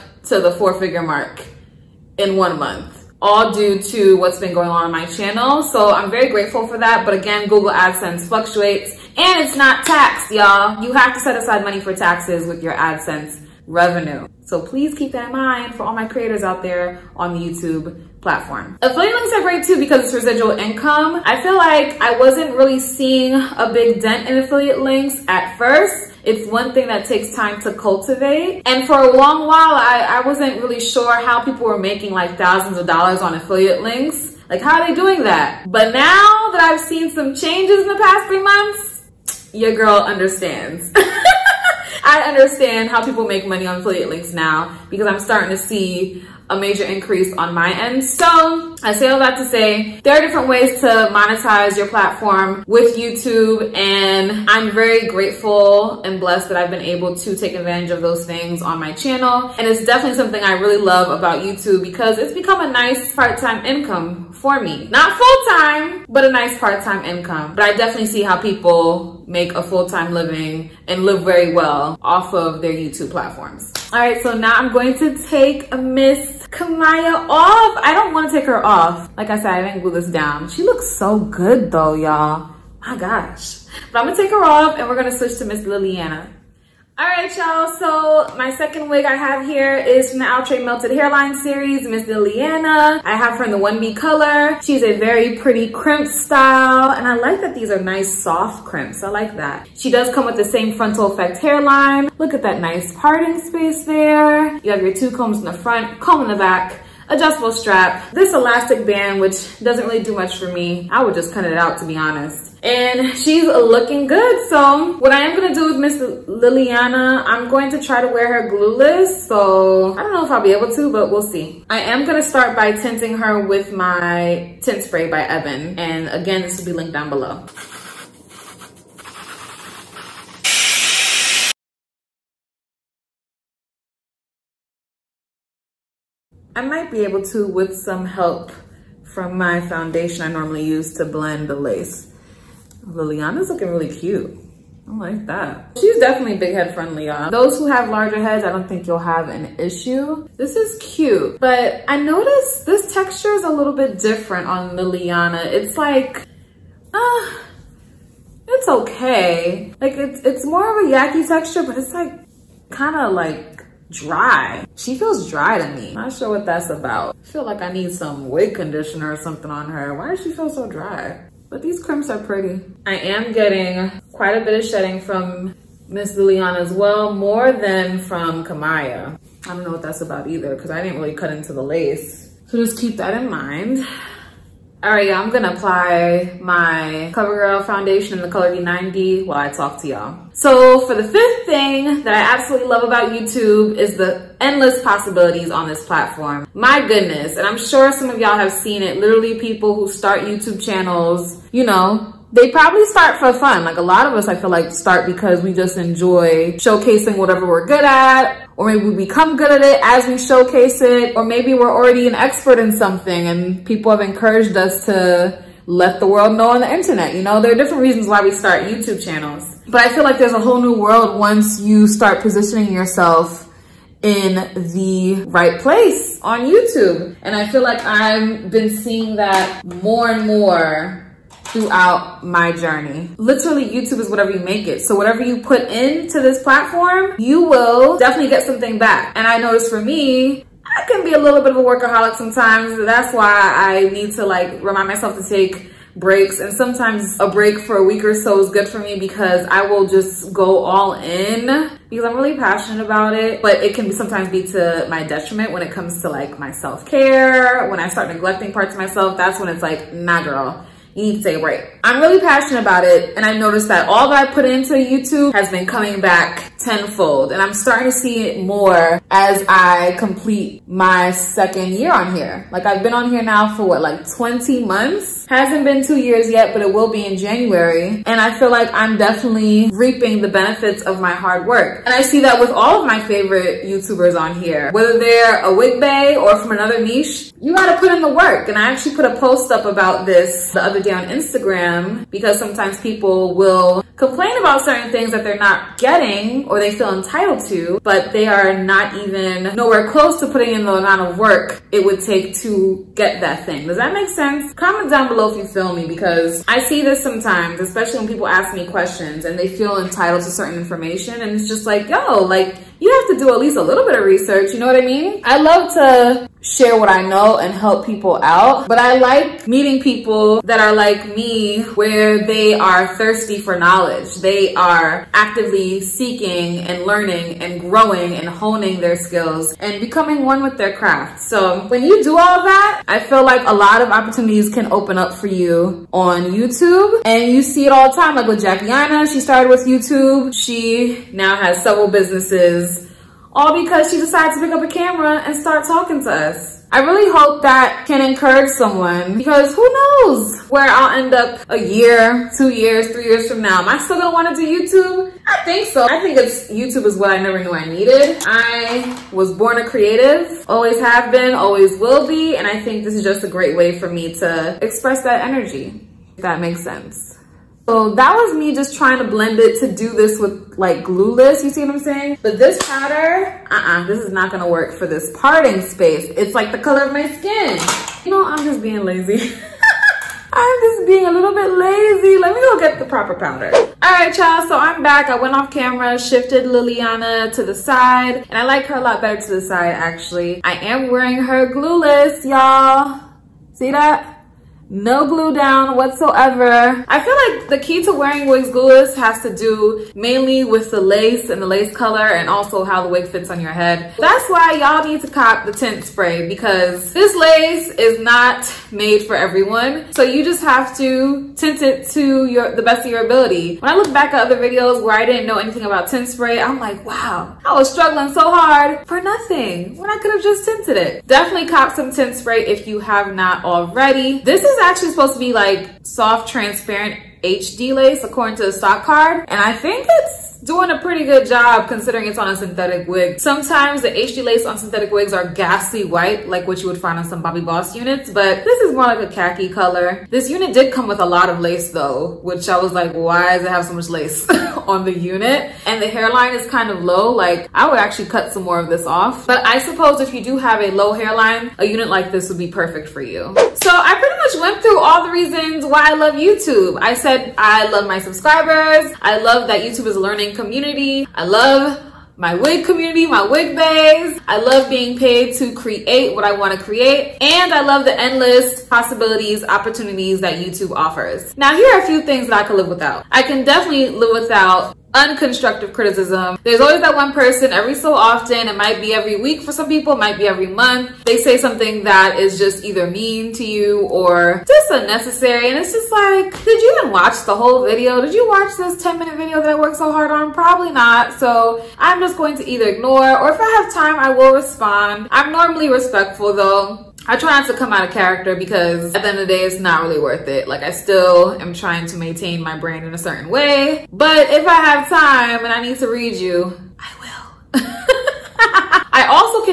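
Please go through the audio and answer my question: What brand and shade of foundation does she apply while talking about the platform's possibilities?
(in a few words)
CoverGirl D90.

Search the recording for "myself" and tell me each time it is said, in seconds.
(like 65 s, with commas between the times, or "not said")
244 s, 258 s.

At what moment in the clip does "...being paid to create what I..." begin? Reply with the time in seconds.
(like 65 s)
464 s.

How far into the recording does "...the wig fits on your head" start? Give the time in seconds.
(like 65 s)
402 s.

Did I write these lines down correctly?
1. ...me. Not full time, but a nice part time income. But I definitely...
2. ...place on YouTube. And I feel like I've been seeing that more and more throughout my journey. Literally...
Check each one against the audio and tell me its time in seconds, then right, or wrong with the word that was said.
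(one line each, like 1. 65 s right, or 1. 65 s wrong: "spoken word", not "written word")
1. 64 s right
2. 225 s right.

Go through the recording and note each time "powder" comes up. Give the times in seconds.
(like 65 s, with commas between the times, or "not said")
372 s, 383 s.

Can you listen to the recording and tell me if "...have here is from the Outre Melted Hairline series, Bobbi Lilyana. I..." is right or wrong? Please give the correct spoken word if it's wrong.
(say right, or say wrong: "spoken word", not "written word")
wrong: "Miss", not "Bobbi".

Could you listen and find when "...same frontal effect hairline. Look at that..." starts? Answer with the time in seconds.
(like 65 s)
100 s.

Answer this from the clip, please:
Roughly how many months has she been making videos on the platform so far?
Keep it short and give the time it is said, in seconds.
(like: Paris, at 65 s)
20, at 274 s.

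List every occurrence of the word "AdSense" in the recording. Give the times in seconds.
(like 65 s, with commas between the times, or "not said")
7 s, 12 s.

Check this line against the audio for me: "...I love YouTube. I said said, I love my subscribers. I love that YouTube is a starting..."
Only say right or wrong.
wrong.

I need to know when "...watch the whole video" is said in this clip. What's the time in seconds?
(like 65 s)
486 s.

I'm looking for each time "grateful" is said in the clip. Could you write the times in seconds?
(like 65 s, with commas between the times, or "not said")
6 s, 55 s.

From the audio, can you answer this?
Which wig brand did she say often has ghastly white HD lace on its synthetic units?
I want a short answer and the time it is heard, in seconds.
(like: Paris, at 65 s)
Bobbi Boss, at 437 s.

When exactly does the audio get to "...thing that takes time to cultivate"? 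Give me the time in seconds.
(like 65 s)
26 s.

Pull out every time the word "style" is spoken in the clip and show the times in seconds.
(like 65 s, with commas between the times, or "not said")
96 s.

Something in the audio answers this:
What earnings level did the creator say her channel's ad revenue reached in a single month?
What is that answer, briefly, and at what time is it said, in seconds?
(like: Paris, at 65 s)
four figure mark, at 0 s.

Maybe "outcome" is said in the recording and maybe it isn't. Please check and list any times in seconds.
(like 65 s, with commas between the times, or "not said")
not said.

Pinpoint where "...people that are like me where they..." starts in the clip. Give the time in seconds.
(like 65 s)
319 s.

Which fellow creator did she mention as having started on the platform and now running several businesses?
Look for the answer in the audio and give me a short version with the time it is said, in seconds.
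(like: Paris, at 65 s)
Anna, at 338 s.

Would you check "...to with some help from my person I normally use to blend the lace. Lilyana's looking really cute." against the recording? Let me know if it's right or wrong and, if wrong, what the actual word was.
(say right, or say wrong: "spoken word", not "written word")
wrong: "foundation", not "person".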